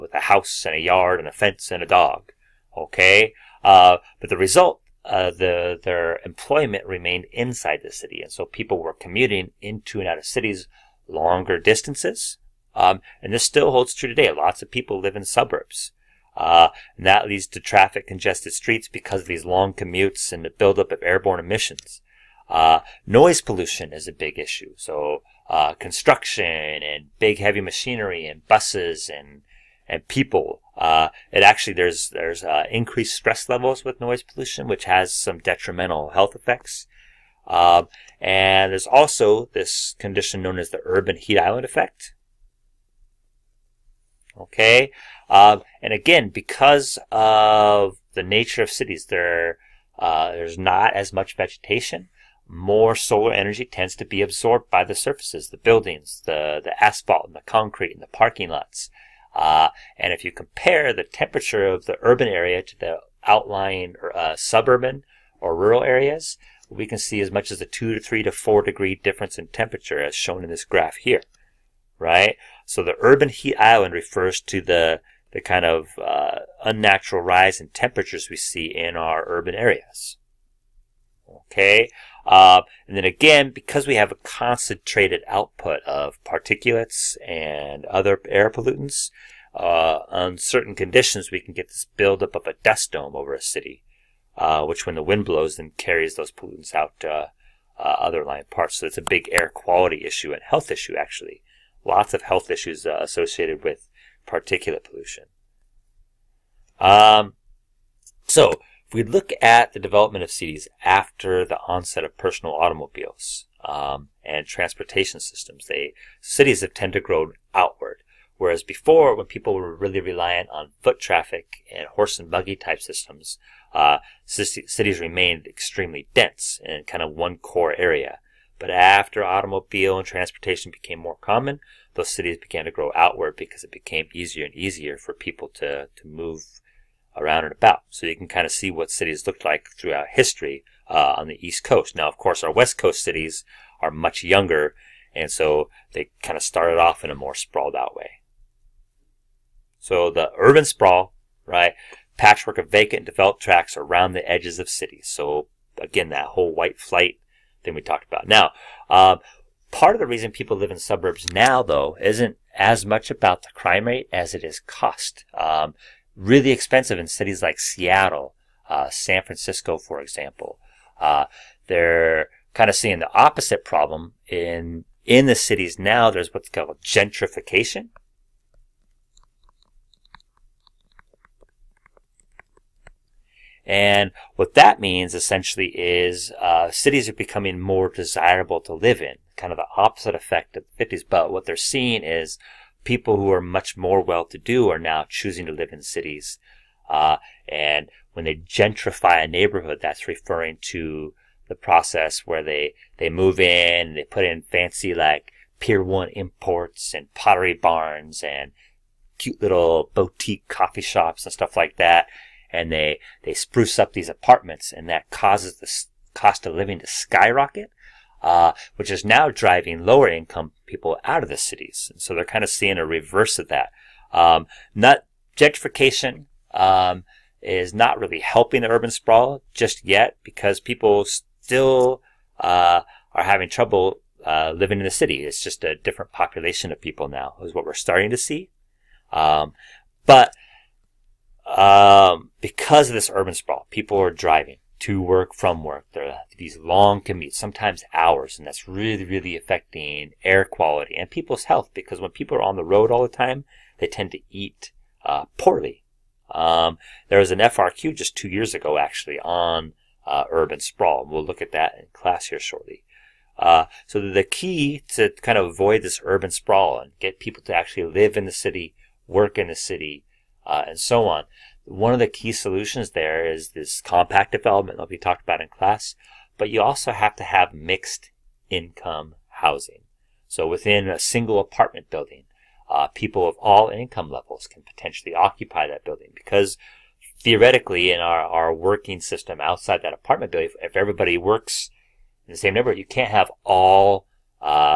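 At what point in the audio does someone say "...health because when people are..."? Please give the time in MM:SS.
04:11.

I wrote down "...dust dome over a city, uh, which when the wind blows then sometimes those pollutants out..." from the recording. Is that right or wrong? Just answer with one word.
wrong.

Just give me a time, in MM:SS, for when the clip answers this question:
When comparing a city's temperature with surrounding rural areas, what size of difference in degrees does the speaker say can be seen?
01:07.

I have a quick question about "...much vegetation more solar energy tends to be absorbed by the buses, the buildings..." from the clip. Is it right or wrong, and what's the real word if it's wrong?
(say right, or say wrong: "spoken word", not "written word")
wrong: "surfaces", not "buses".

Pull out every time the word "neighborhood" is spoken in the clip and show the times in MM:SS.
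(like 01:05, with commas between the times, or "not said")
03:19, 04:52.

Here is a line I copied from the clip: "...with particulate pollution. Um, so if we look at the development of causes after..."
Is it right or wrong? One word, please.
wrong.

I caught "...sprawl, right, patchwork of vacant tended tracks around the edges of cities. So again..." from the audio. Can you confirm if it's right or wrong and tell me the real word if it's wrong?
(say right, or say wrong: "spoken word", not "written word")
wrong: "developed", not "tended".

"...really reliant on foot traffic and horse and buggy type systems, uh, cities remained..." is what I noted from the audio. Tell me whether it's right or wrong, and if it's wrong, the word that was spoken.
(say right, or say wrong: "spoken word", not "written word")
right.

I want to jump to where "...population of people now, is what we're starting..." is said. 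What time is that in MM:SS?
03:56.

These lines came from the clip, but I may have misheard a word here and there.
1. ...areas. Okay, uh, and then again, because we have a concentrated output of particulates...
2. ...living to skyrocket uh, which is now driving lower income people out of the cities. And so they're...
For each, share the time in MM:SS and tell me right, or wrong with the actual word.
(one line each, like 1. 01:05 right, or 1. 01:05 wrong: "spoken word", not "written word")
1. 01:19 right
2. 03:36 right.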